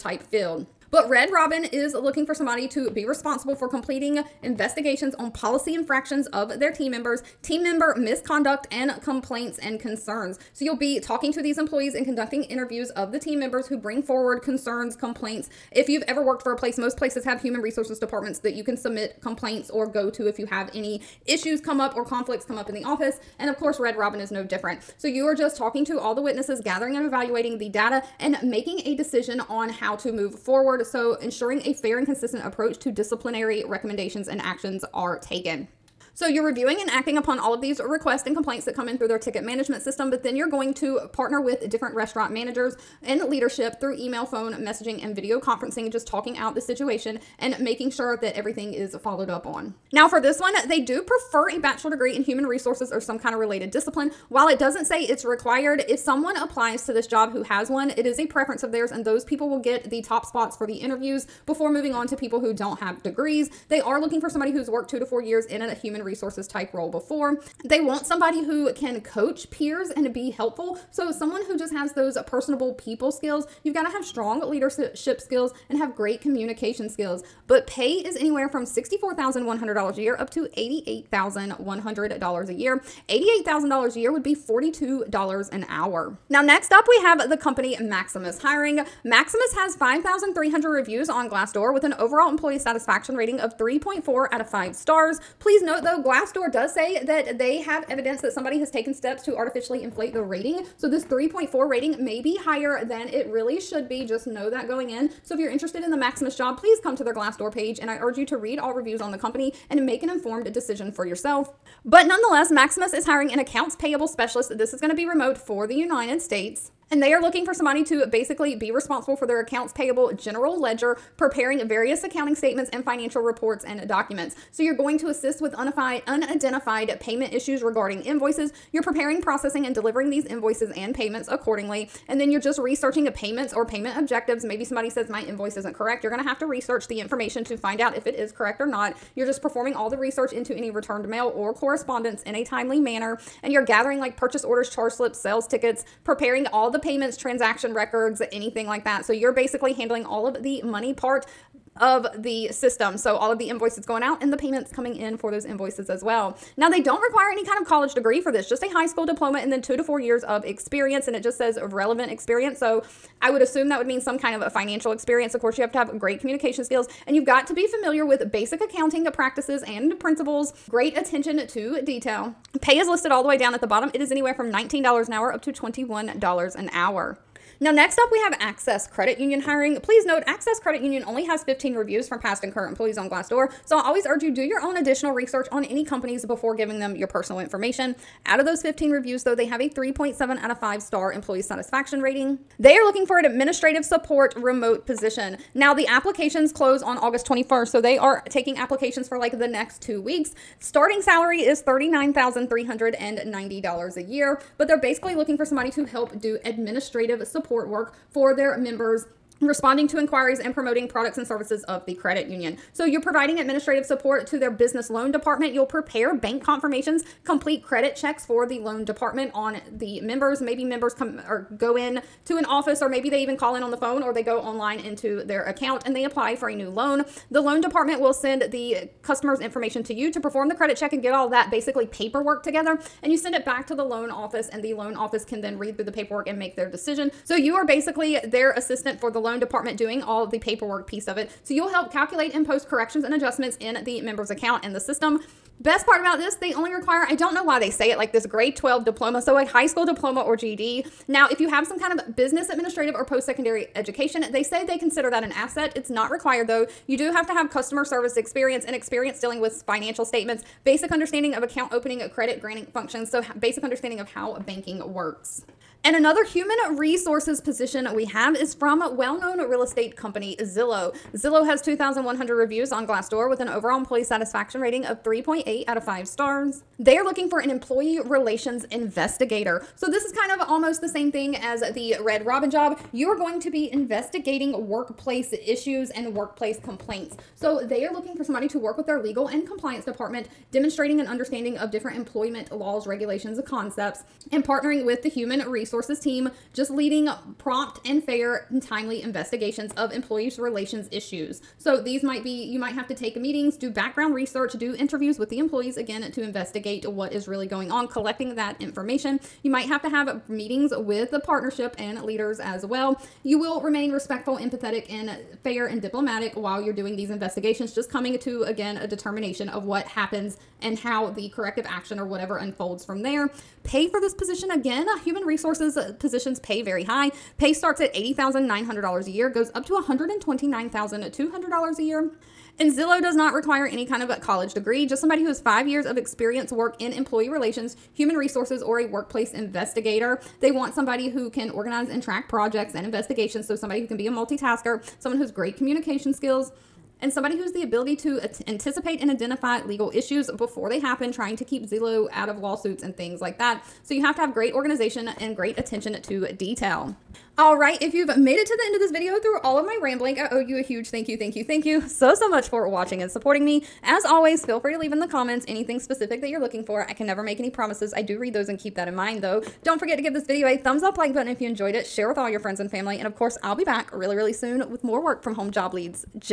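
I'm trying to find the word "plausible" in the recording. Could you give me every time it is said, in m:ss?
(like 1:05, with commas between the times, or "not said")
not said.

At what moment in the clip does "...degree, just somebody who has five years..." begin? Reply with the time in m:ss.
5:34.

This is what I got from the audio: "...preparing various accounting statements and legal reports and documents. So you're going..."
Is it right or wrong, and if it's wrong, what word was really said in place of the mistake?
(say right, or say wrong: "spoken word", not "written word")
wrong: "financial", not "legal".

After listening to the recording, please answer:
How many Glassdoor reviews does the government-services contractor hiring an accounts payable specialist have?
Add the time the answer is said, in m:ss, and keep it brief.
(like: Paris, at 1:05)
5,300, at 1:29.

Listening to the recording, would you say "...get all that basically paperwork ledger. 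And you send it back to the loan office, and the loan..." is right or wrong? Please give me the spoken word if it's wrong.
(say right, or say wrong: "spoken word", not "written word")
wrong: "together", not "ledger".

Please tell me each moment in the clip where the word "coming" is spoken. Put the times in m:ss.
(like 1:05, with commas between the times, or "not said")
2:34, 5:17.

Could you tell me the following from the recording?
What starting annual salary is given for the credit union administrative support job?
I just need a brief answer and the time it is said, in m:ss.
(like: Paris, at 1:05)
$39,390, at 3:21.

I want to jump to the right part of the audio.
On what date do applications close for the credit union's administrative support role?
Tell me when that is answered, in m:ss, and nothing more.
3:16.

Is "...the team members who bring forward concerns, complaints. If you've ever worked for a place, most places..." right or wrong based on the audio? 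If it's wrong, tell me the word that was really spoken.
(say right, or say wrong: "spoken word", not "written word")
right.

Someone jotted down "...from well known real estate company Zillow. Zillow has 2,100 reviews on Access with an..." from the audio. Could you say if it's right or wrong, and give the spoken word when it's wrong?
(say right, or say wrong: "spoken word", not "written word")
wrong: "Glassdoor", not "Access".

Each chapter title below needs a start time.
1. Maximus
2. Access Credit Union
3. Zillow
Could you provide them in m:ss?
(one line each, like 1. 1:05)
1. 1:27
2. 2:56
3. 4:25.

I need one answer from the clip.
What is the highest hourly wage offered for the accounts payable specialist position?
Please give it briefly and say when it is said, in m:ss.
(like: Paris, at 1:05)
$21, at 2:55.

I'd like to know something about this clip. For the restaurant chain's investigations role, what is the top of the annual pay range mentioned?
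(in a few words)
$88,100.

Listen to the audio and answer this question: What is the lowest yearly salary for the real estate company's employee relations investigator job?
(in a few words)
$80,900.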